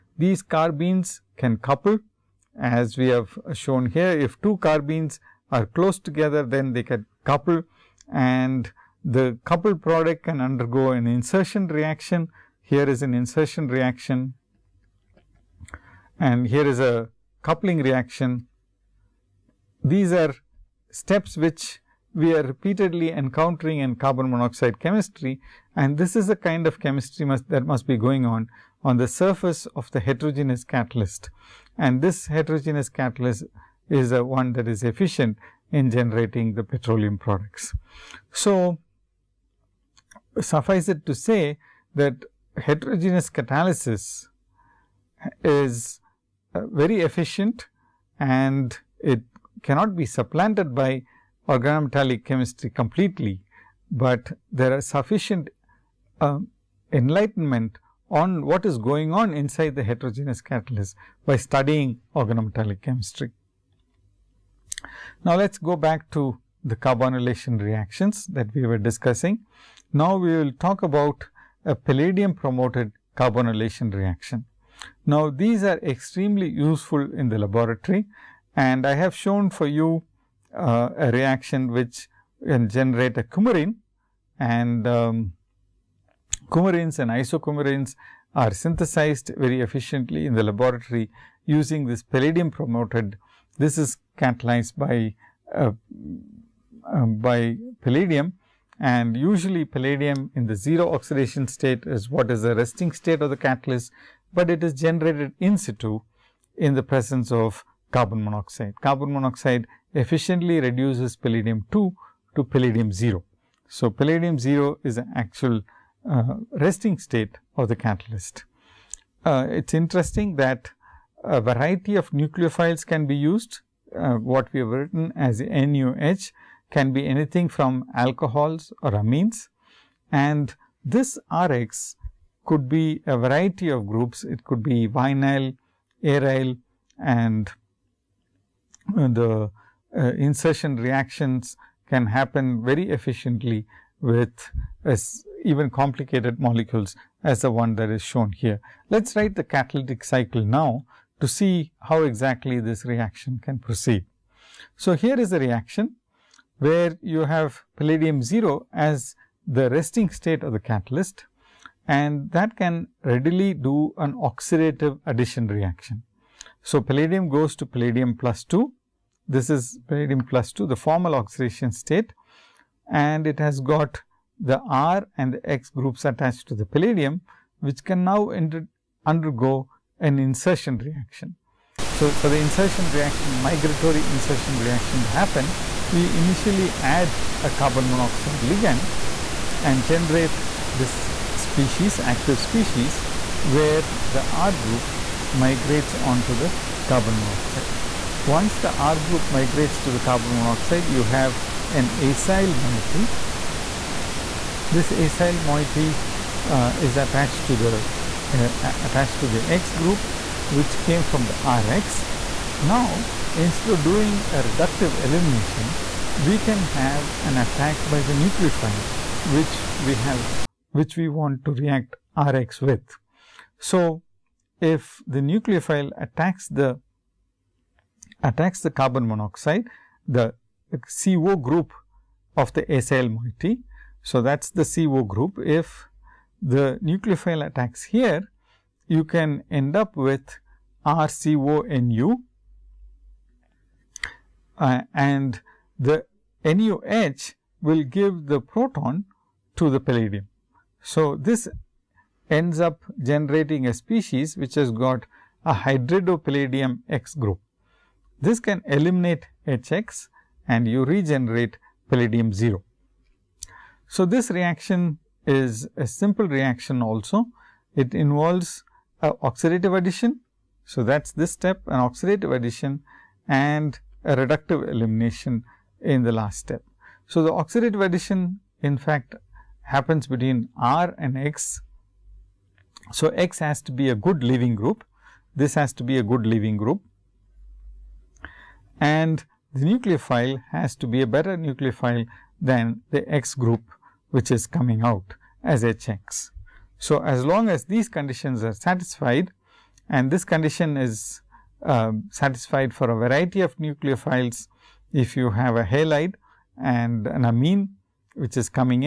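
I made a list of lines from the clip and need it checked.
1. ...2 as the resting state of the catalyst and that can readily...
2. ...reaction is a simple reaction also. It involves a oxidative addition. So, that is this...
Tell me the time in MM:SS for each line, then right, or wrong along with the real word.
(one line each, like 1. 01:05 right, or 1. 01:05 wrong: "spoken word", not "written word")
1. 02:38 wrong: "0", not "2"
2. 04:24 right.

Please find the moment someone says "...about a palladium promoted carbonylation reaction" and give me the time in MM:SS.
01:10.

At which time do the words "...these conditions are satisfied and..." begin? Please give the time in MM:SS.
04:57.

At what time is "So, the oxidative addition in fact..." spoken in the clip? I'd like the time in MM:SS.
04:37.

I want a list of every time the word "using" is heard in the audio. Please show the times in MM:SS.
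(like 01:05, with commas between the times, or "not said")
01:31.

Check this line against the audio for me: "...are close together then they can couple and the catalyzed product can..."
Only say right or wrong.
wrong.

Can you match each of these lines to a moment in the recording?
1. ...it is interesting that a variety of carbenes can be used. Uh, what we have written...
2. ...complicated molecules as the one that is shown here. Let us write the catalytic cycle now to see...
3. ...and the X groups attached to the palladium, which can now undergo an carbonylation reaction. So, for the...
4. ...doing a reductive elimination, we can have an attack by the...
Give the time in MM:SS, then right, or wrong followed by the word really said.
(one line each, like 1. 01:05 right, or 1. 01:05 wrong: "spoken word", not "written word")
1. 01:59 wrong: "nucleophiles", not "carbenes"
2. 02:25 right
3. 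02:55 wrong: "insertion", not "carbonylation"
4. 03:33 right.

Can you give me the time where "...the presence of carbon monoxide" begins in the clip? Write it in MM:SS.
01:46.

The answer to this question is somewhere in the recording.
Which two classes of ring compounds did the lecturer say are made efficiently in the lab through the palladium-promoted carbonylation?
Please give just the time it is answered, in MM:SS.
01:26.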